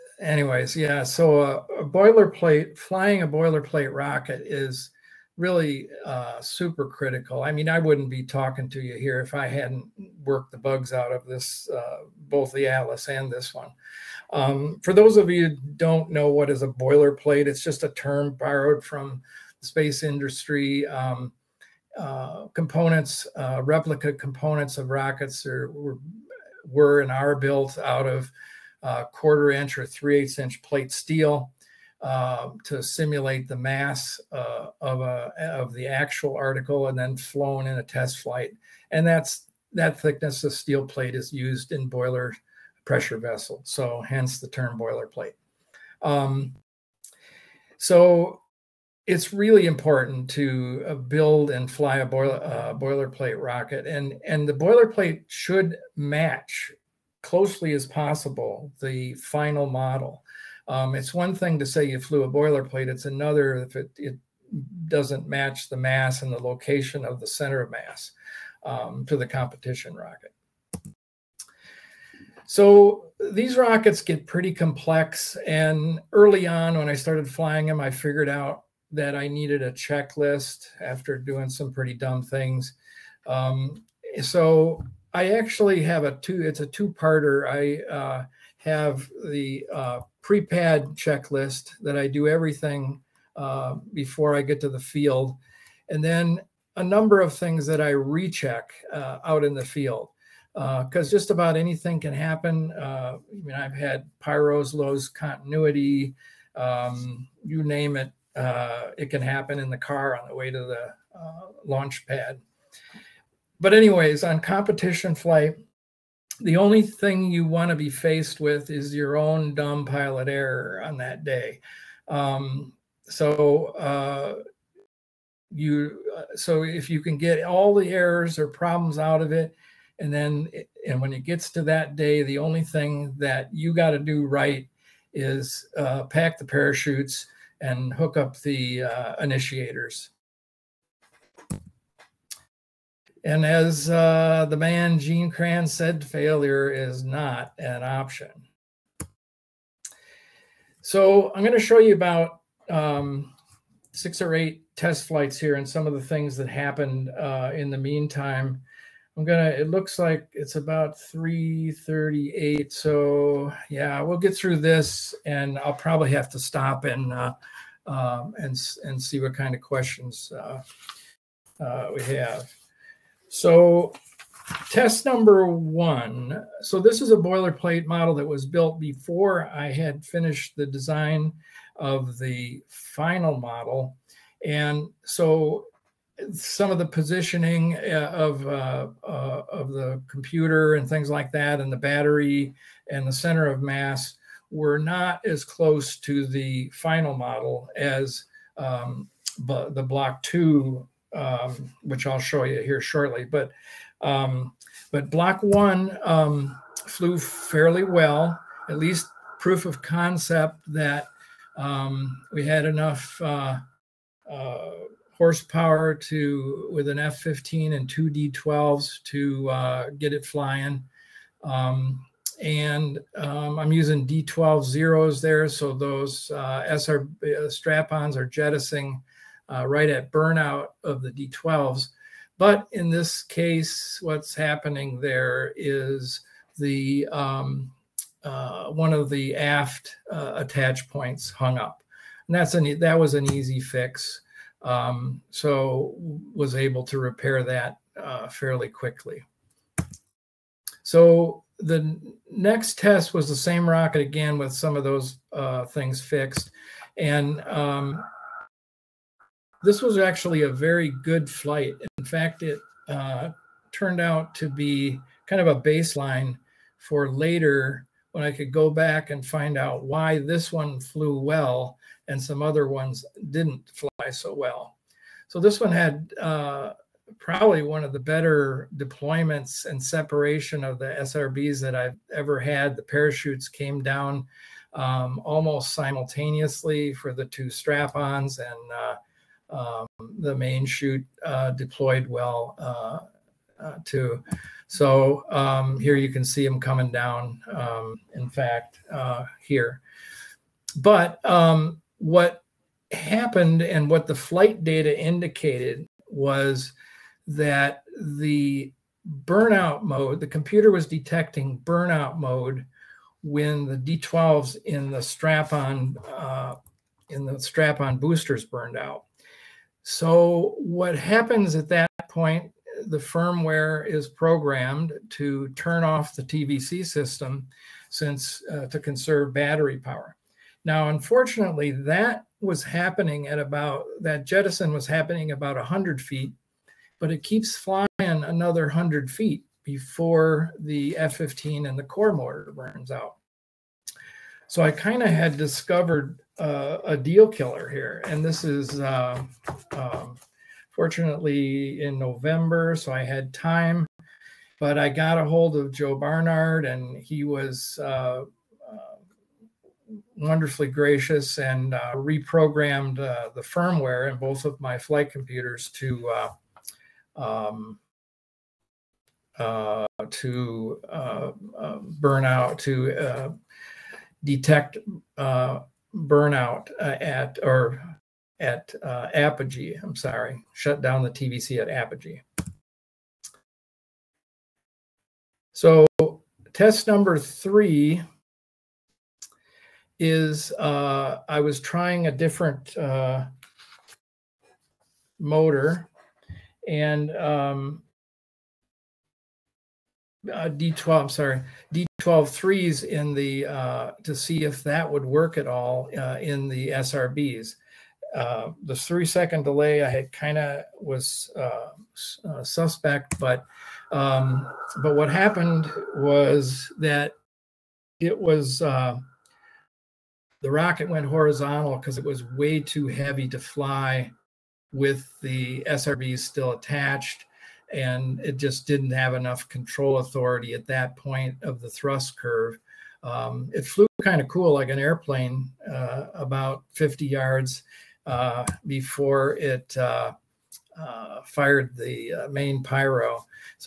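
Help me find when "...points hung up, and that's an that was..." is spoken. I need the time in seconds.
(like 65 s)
240 s.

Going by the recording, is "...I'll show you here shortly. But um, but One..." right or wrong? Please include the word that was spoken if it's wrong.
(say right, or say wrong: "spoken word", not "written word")
wrong: "Block", not "One".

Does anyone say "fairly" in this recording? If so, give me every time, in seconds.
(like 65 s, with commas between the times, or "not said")
207 s, 248 s.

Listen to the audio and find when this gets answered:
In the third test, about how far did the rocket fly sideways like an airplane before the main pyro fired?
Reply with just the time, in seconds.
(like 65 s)
436 s.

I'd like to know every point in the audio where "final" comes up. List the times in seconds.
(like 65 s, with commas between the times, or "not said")
59 s, 182 s, 196 s.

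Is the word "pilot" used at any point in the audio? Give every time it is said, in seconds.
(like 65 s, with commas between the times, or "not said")
119 s.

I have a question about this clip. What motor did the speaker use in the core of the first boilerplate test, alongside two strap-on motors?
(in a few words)
F15.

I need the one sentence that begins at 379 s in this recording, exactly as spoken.
I'm sorry, shut down the TVC at apogee.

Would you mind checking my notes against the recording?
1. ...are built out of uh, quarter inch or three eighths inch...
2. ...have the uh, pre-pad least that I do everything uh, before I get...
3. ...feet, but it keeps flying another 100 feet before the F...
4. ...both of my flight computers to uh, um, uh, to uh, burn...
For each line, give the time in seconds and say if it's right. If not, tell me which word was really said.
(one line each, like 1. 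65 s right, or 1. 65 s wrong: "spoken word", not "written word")
1. 27 s right
2. 88 s wrong: "checklist", not "least"
3. 336 s right
4. 364 s right.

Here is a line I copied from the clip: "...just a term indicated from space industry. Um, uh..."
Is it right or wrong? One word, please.
wrong.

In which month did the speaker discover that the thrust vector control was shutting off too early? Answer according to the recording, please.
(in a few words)
November.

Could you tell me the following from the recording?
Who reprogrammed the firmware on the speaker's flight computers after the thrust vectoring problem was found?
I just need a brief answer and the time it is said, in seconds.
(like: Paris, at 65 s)
Joe Barnard, at 355 s.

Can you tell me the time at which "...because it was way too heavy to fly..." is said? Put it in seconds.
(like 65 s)
421 s.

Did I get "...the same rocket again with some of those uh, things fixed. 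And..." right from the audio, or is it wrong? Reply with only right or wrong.
right.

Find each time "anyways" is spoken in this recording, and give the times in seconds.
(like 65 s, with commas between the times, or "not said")
0 s, 113 s.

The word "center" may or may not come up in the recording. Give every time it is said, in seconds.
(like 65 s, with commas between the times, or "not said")
67 s, 193 s.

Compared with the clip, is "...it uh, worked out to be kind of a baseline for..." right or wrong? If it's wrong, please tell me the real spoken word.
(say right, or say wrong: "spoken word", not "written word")
wrong: "turned", not "worked".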